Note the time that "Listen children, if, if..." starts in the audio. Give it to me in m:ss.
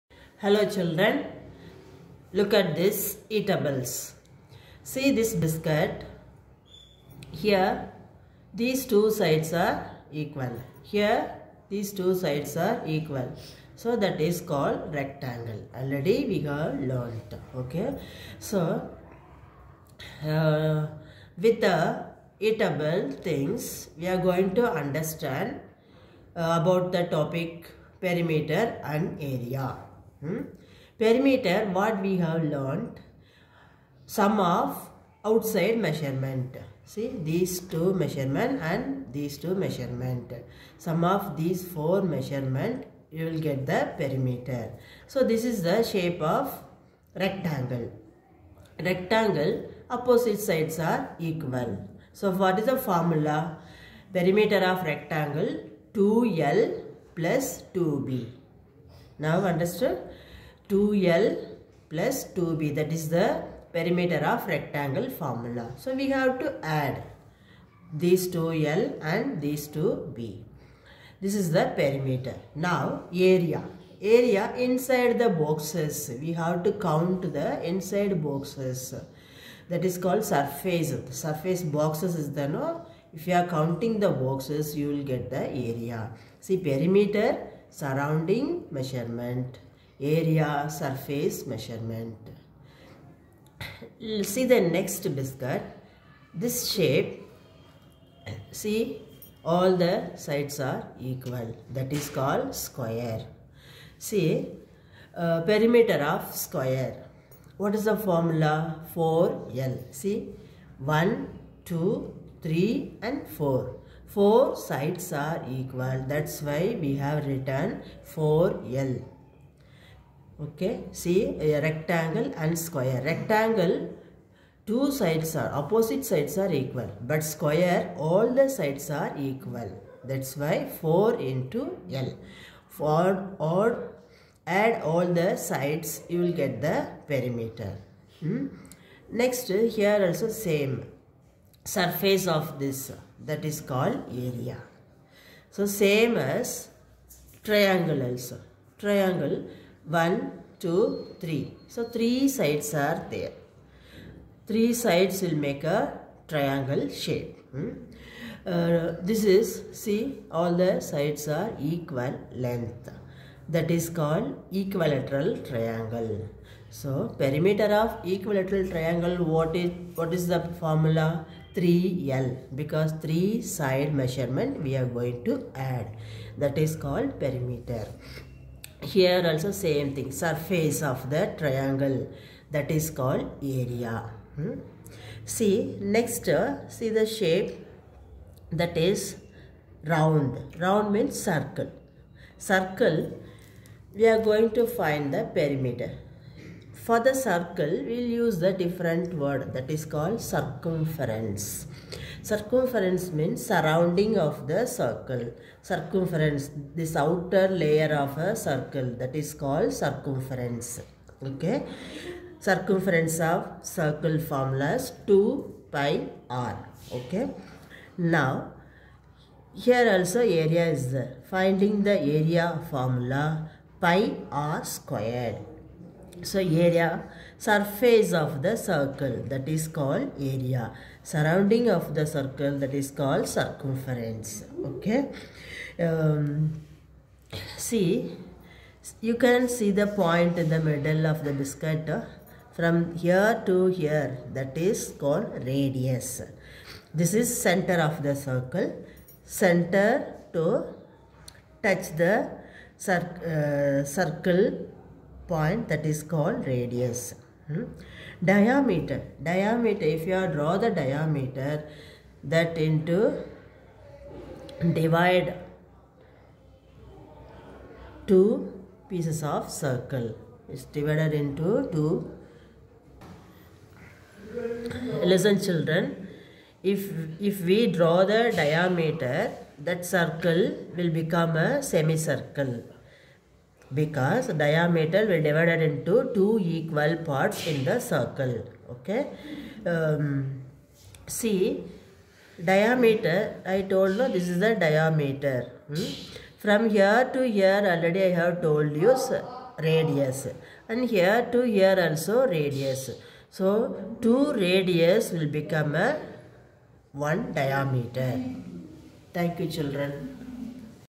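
4:35.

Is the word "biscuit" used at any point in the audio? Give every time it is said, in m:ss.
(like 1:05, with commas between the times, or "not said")
0:05, 1:35, 4:01.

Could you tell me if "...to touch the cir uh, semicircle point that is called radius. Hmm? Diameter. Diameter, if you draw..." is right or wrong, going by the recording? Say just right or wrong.
wrong.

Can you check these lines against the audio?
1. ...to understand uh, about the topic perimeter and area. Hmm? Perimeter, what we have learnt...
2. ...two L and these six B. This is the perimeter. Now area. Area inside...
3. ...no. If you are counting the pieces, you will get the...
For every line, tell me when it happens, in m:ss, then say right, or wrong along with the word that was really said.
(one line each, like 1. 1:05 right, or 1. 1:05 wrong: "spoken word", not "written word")
1. 0:24 right
2. 1:08 wrong: "two", not "six"
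3. 1:22 wrong: "boxes", not "pieces".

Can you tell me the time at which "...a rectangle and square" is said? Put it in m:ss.
2:01.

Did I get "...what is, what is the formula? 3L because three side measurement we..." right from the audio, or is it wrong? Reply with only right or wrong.
right.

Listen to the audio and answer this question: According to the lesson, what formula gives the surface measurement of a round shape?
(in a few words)
pi r squared.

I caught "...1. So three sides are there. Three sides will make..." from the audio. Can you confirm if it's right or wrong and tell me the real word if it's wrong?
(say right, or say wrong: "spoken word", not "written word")
wrong: "3", not "1".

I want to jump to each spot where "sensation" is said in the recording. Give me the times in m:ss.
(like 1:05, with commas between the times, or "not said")
not said.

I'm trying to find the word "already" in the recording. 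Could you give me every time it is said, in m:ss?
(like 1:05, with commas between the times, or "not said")
0:15, 4:57.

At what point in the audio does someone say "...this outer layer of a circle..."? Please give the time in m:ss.
3:26.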